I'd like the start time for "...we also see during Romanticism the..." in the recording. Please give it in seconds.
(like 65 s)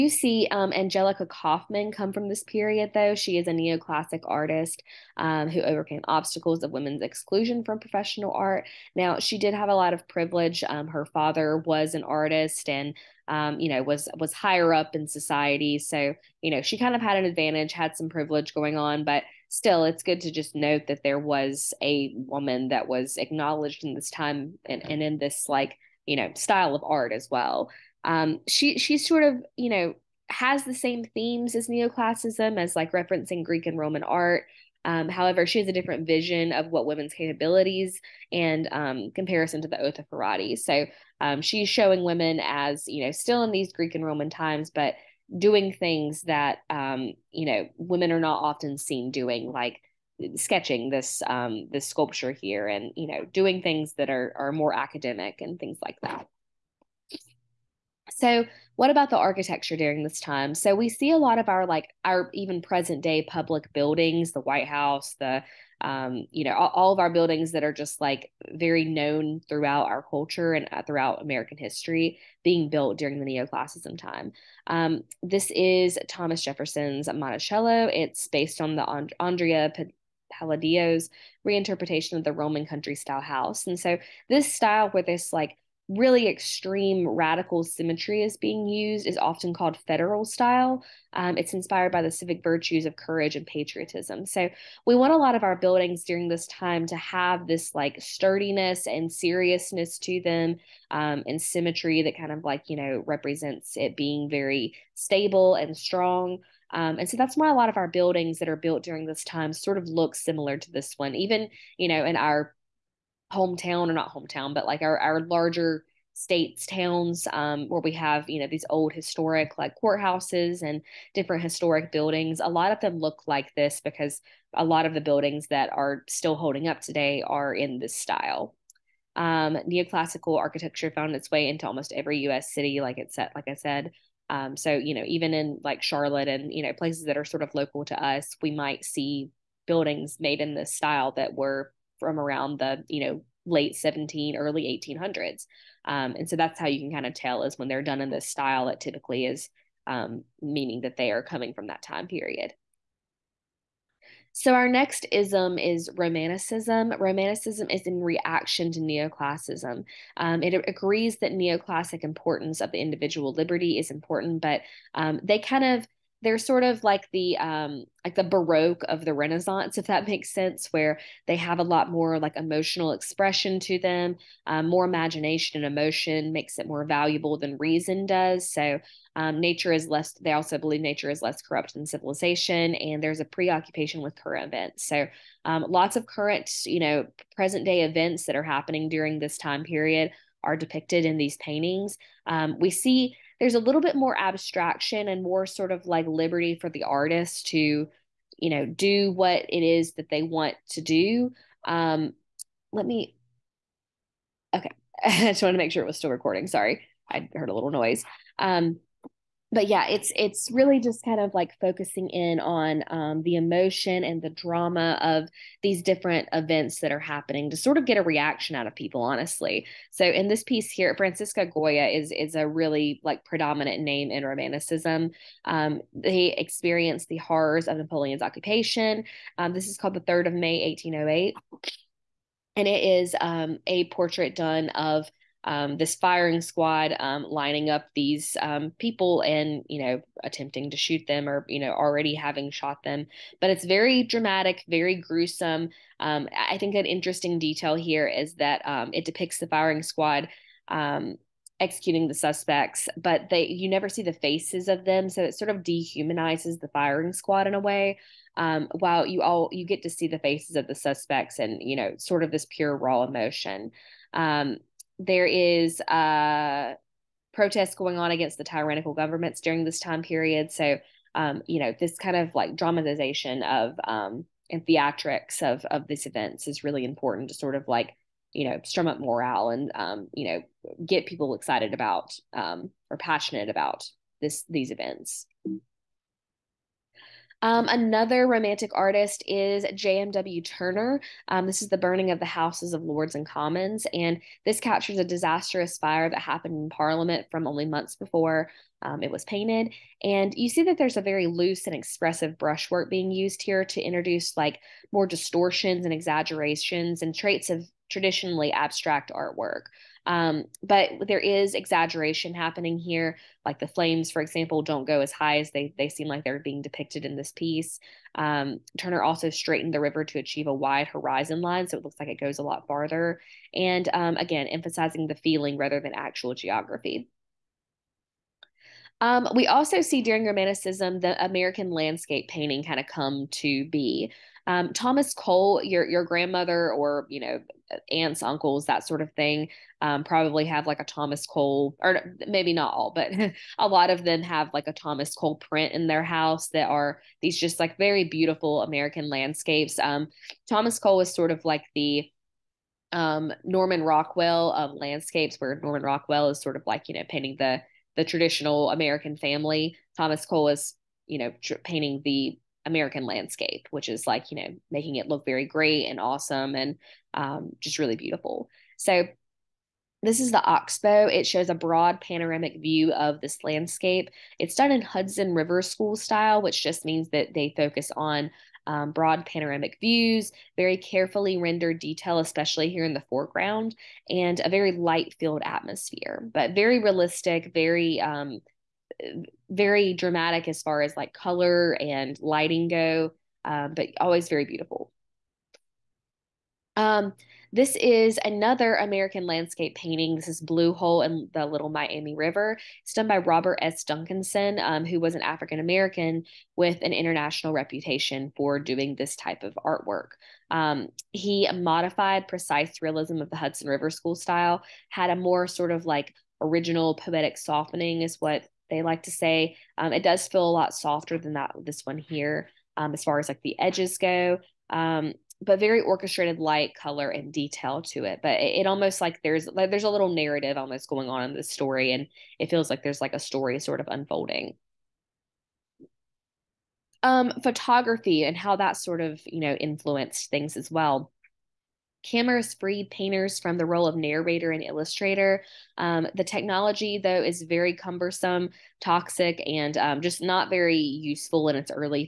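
329 s.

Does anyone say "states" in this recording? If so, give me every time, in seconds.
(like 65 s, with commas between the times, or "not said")
116 s.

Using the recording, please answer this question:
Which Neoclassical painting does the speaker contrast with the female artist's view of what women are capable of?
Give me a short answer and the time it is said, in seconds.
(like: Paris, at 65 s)
Oath of Horatii, at 39 s.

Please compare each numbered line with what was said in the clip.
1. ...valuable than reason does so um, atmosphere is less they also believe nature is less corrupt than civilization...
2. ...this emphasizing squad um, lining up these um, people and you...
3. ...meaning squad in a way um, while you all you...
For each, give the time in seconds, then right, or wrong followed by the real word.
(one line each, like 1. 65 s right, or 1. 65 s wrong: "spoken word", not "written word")
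1. 176 s wrong: "nature", not "atmosphere"
2. 235 s wrong: "firing", not "emphasizing"
3. 256 s wrong: "firing", not "meaning".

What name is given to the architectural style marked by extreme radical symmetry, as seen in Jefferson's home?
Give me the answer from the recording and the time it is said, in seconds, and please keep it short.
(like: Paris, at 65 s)
federal style, at 89 s.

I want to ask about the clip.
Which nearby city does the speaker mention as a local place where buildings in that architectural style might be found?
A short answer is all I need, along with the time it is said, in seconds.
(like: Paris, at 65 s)
Charlotte, at 135 s.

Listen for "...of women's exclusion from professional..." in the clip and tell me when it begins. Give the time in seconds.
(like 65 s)
6 s.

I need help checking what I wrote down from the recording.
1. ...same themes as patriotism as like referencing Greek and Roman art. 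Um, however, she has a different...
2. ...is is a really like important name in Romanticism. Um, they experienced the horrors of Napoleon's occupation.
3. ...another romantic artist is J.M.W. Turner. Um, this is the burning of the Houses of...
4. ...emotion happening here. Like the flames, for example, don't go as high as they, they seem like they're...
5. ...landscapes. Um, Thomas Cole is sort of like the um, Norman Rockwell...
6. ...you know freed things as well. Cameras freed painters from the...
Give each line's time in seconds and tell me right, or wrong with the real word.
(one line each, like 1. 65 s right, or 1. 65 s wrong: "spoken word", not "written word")
1. 30 s wrong: "neoclassicism", not "patriotism"
2. 221 s wrong: "predominant", not "important"
3. 287 s right
4. 311 s wrong: "exaggeration", not "emotion"
5. 349 s right
6. 439 s wrong: "influenced", not "freed".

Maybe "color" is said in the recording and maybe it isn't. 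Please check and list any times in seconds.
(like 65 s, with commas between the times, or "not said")
391 s, 426 s.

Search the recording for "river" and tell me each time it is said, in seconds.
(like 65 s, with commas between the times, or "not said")
319 s, 375 s, 402 s, 413 s.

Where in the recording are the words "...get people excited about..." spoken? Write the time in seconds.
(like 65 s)
280 s.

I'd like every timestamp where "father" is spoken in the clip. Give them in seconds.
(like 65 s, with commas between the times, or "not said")
11 s.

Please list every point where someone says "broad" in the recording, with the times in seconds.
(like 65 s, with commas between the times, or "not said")
371 s, 378 s.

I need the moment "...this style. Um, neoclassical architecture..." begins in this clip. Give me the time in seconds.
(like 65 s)
127 s.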